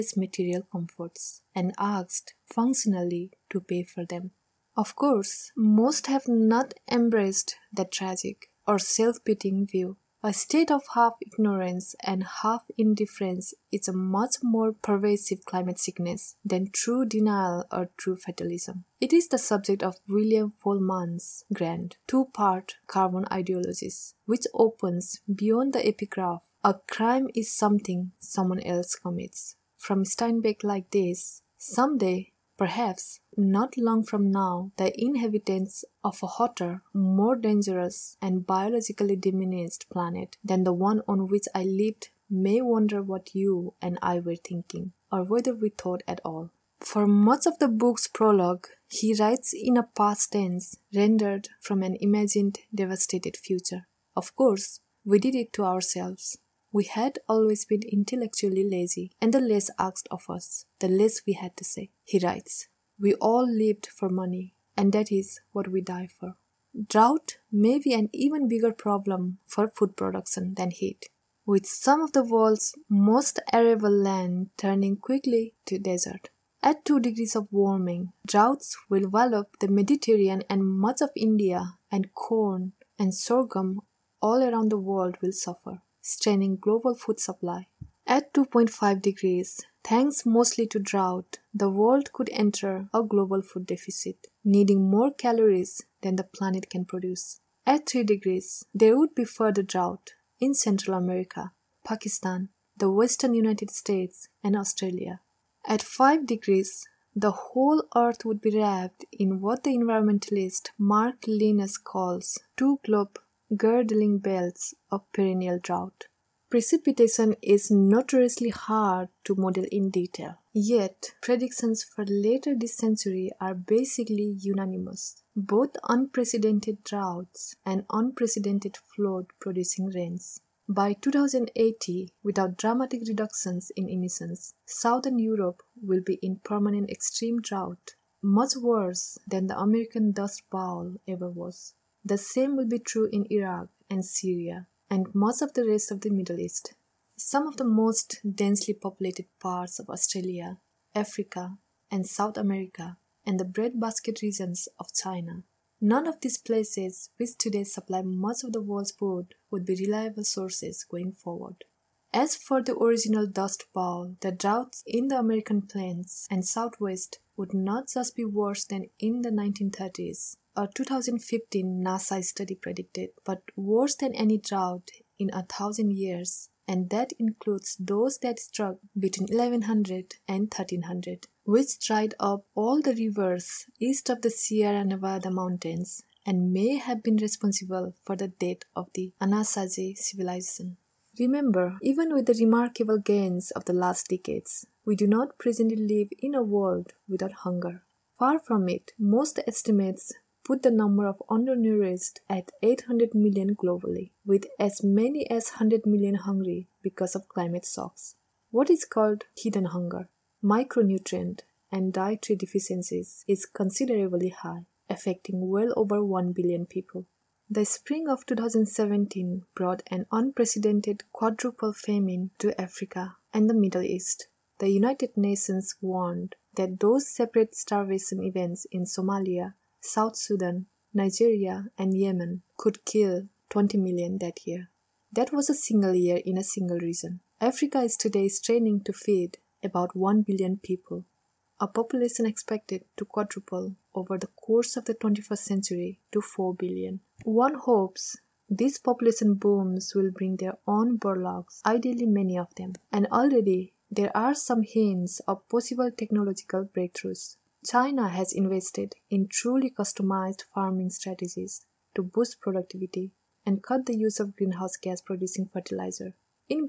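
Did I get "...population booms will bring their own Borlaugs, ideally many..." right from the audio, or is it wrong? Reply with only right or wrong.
right.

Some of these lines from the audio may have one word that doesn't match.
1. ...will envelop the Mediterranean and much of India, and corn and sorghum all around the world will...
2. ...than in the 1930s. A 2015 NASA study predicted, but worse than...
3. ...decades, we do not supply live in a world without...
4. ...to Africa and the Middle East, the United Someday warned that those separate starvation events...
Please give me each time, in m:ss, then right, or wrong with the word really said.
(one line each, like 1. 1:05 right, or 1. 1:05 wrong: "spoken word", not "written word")
1. 1:18 right
2. 2:48 right
3. 3:14 wrong: "presently", not "supply"
4. 3:42 wrong: "Nations", not "Someday".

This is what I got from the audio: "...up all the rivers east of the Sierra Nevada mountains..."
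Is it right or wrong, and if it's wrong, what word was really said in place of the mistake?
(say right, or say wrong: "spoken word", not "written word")
right.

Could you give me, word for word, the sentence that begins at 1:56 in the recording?
Precipitation is notoriously hard to model in detail, yet predictions for later this century are basically unanimous.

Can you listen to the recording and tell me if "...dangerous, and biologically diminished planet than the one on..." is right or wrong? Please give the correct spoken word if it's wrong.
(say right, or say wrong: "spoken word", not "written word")
right.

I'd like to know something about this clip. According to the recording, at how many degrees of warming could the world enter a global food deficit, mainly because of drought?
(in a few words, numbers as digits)
2.5 degrees.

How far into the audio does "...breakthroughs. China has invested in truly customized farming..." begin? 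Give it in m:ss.
4:16.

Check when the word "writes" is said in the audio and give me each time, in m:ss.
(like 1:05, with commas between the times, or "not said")
0:49, 1:02.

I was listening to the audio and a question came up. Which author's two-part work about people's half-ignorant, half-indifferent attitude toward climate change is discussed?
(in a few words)
William Vollmann.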